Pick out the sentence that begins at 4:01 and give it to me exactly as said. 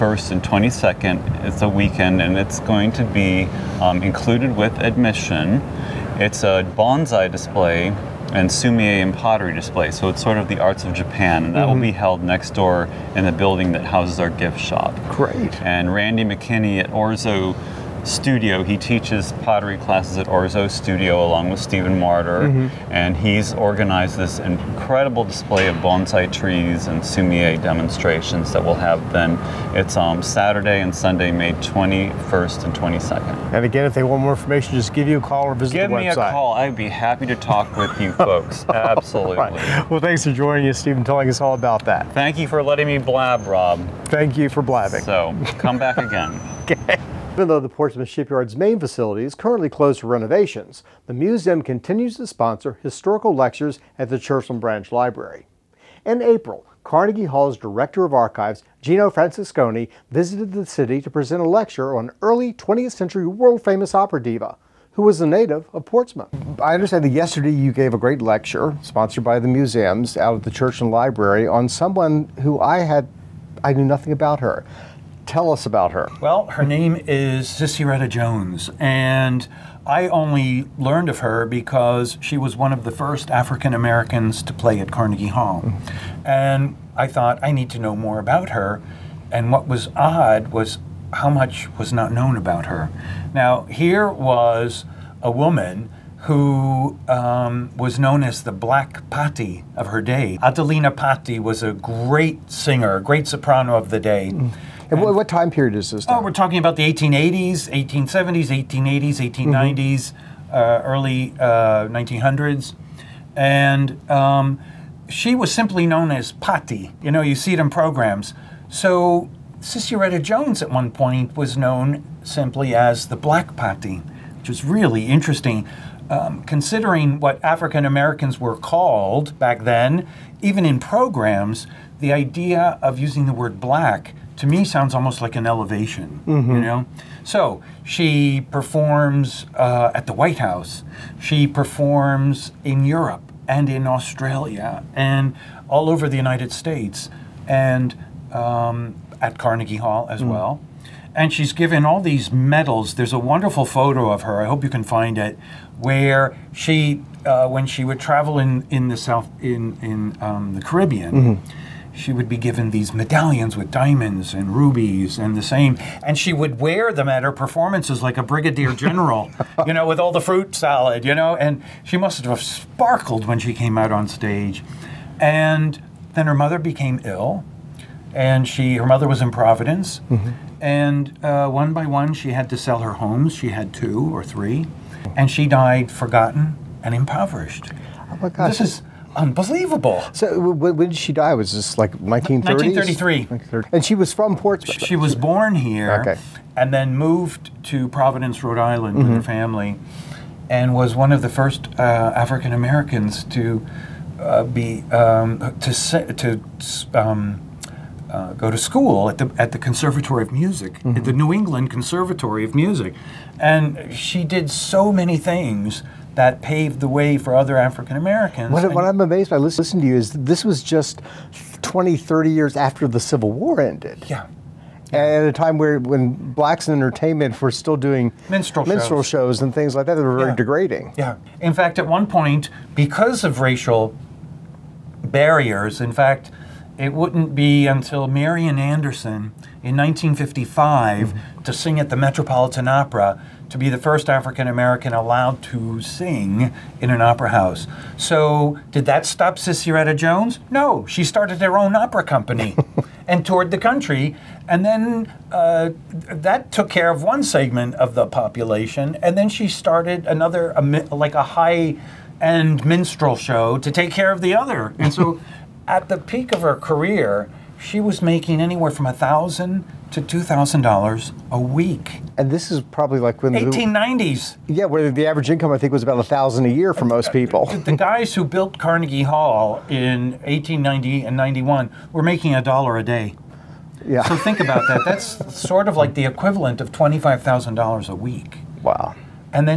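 to sing at the Metropolitan Opera to be the first African American allowed to sing in an opera house.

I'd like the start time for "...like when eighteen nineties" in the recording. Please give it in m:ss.
4:32.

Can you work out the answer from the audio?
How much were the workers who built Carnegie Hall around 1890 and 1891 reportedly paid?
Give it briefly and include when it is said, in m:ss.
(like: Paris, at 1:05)
A dollar a day, at 4:42.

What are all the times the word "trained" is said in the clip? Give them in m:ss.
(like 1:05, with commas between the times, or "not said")
not said.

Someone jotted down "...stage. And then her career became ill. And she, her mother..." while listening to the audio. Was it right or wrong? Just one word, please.
wrong.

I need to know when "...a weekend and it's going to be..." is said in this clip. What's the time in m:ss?
0:01.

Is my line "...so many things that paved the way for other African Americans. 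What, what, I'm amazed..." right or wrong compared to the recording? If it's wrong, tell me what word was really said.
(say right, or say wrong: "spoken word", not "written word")
right.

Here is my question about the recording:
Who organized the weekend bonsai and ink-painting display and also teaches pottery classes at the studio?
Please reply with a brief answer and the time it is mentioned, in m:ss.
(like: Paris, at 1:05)
Randy McKinney, at 0:15.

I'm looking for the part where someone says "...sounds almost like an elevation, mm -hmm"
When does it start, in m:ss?
2:14.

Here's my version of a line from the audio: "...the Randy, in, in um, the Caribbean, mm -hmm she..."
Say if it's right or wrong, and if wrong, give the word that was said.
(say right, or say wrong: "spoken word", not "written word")
wrong: "South", not "Randy".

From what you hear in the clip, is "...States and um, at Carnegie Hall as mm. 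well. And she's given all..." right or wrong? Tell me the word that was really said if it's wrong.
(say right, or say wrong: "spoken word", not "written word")
right.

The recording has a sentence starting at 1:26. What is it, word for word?
And I thought, I need to know more about her.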